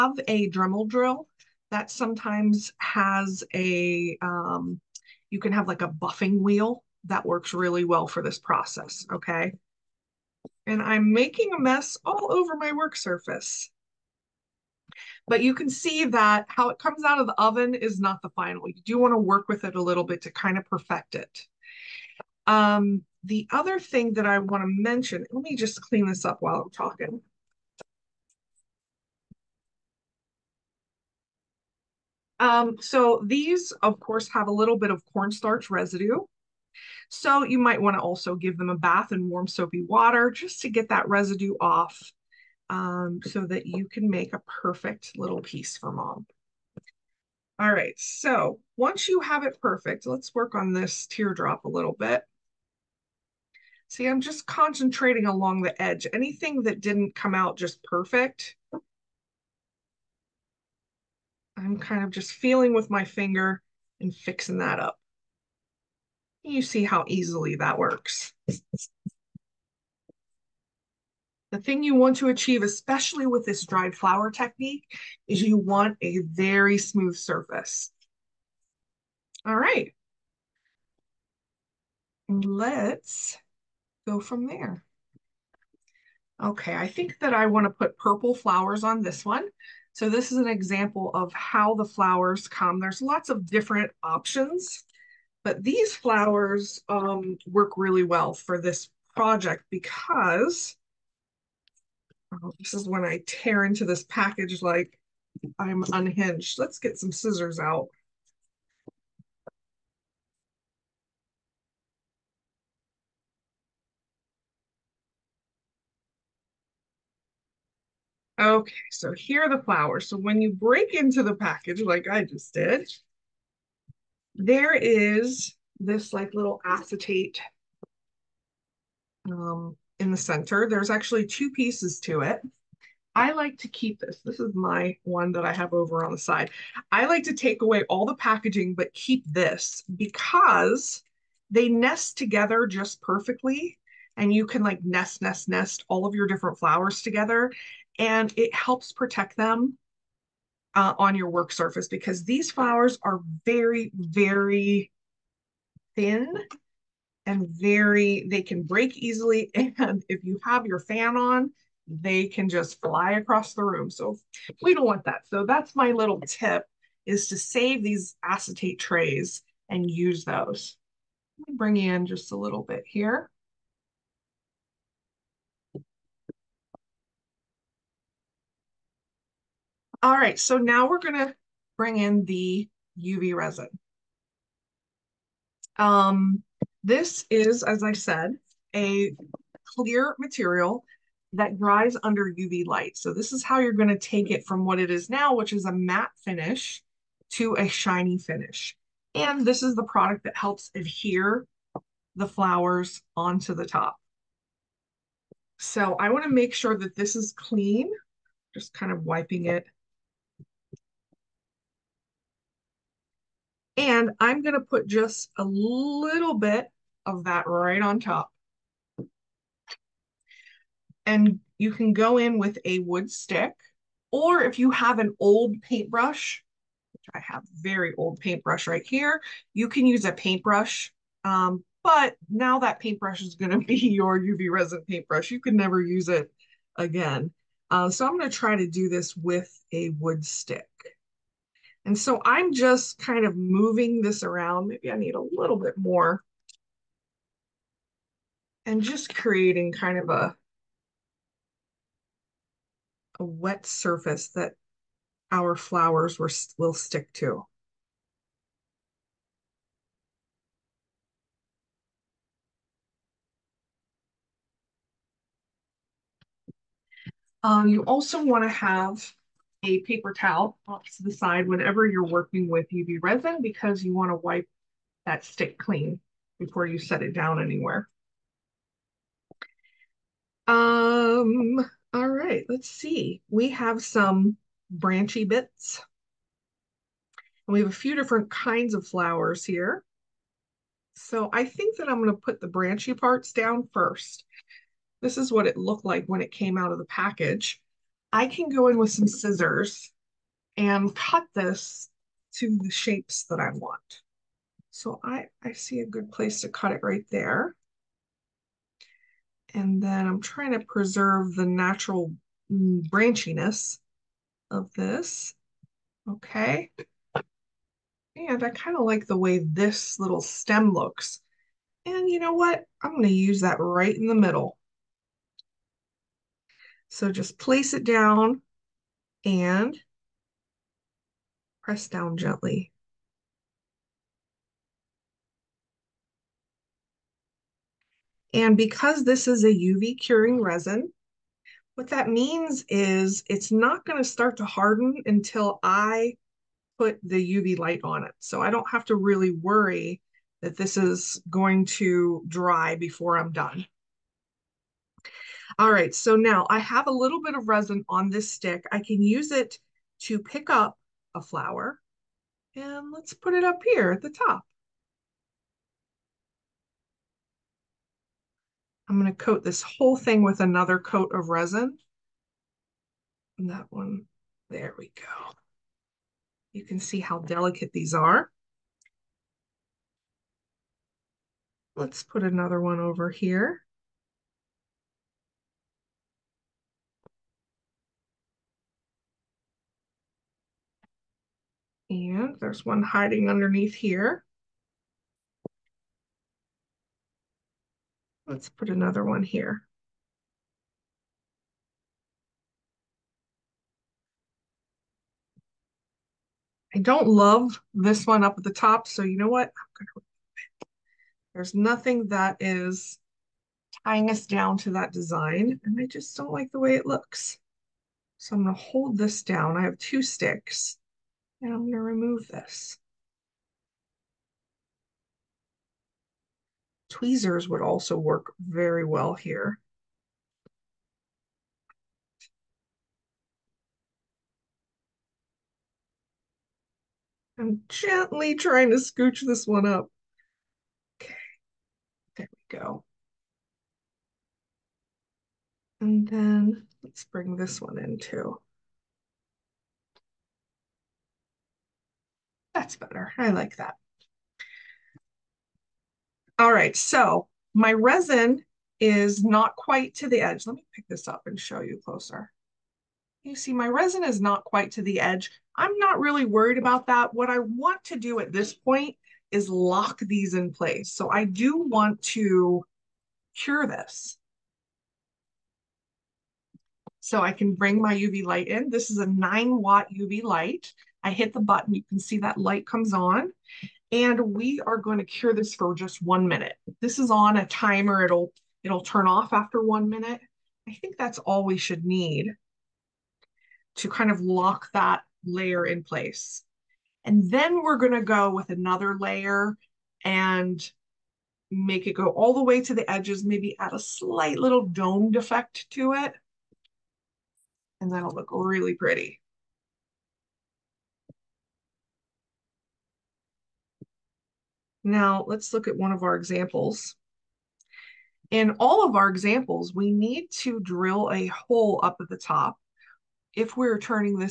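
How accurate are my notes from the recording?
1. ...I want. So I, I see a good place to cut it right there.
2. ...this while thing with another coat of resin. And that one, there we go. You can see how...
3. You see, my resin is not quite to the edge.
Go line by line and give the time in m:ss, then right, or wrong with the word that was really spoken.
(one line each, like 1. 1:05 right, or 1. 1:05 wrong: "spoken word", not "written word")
1. 5:03 right
2. 6:09 wrong: "whole", not "while"
3. 7:43 right.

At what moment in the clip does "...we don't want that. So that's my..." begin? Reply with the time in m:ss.
2:44.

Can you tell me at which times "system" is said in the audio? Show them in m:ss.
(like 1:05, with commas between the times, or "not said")
not said.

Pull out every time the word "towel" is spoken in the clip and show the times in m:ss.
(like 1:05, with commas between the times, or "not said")
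4:30.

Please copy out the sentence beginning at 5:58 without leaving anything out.
I can use it to pick up a flower and let's put it up here at the top.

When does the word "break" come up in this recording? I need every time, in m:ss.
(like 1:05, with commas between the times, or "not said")
2:00, 2:38.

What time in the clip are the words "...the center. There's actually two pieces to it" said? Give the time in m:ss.
2:10.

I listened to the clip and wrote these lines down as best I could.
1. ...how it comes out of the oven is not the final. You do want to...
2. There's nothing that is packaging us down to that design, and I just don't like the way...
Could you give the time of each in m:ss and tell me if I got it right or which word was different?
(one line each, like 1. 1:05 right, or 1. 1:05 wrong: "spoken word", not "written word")
1. 0:16 right
2. 6:51 wrong: "tying", not "packaging".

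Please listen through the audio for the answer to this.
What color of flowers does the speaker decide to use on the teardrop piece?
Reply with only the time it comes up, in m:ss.
1:27.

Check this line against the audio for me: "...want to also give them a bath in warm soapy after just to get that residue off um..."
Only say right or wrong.
wrong.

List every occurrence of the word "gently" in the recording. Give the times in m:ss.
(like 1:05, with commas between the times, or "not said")
5:32, 7:17.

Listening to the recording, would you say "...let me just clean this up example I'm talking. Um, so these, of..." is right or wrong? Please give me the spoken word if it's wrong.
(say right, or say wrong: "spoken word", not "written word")
wrong: "while", not "example".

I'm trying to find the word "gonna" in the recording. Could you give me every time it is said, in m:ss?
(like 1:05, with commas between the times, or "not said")
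3:00, 3:13, 6:08, 6:58.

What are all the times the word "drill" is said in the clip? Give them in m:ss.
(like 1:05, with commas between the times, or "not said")
0:00, 8:40.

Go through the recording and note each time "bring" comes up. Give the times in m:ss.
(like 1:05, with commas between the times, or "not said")
2:51, 3:01, 7:27, 7:57.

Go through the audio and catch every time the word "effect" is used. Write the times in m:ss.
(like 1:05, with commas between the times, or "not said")
8:25.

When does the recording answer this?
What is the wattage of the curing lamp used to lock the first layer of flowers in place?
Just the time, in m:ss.
7:59.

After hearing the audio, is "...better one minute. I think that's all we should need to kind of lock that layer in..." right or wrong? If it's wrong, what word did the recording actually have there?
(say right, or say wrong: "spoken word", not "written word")
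wrong: "after", not "better".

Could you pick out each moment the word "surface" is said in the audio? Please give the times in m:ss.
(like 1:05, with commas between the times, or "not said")
0:12, 1:17, 2:31, 4:13.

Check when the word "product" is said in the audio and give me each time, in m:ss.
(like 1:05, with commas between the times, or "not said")
3:19.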